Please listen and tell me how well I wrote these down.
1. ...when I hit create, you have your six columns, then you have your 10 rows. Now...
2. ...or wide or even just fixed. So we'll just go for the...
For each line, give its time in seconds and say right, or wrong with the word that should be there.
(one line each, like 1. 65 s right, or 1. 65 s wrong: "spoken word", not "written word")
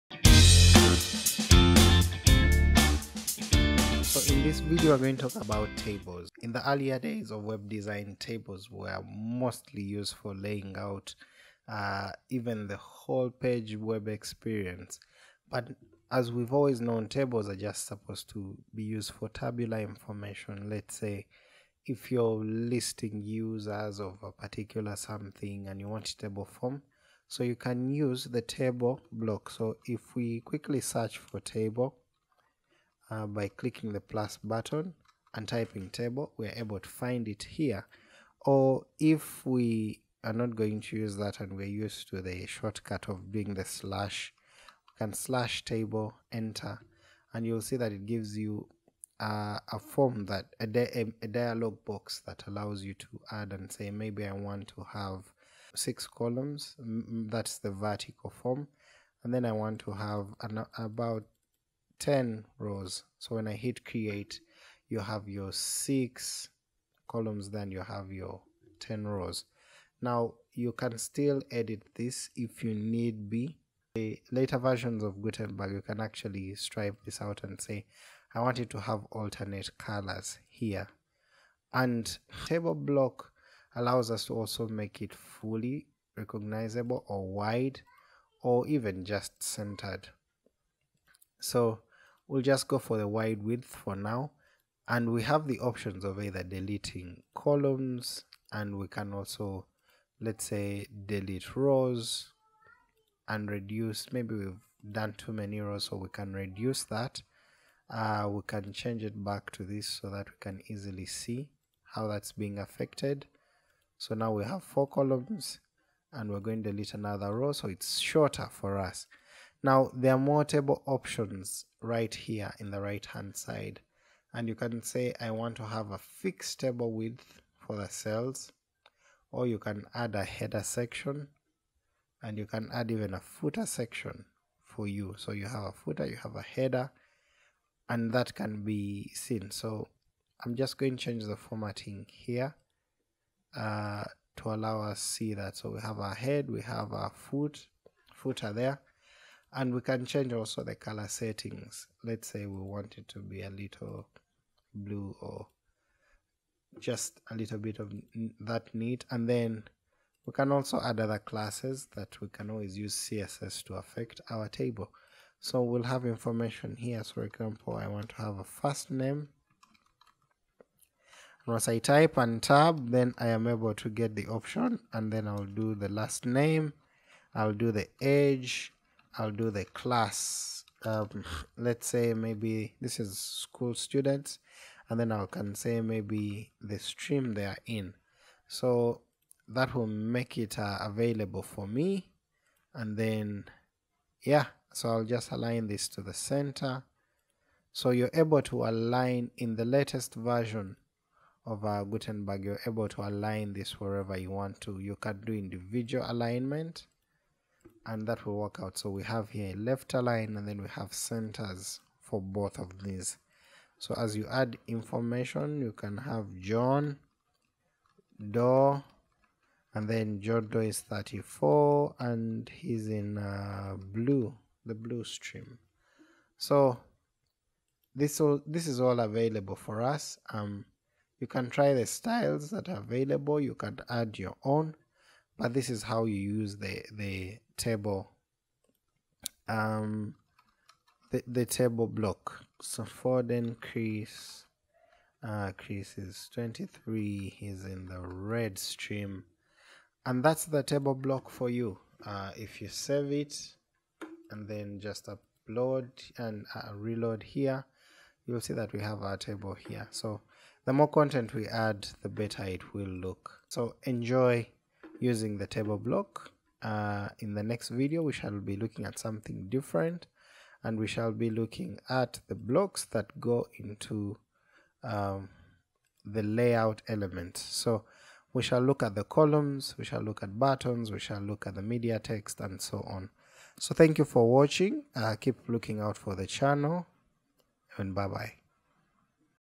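1. 63 s right
2. 87 s wrong: "centered", not "fixed".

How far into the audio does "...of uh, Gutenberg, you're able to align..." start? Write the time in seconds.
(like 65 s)
201 s.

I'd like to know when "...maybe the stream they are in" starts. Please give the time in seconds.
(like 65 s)
185 s.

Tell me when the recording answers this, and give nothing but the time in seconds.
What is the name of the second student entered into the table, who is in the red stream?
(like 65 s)
245 s.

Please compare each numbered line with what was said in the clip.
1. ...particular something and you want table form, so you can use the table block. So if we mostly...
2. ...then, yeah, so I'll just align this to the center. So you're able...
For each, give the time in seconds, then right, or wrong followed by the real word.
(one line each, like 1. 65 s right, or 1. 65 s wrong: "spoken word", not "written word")
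1. 24 s wrong: "quickly", not "mostly"
2. 192 s right.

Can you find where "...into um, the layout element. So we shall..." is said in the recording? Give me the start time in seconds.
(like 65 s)
273 s.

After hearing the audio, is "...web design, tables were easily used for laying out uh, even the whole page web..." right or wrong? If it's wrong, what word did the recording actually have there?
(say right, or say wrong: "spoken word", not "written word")
wrong: "mostly", not "easily".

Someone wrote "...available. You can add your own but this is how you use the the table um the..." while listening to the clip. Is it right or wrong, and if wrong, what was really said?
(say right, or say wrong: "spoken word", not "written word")
right.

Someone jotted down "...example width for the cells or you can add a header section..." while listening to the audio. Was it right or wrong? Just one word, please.
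wrong.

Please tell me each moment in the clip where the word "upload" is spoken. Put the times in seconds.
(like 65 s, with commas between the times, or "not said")
255 s.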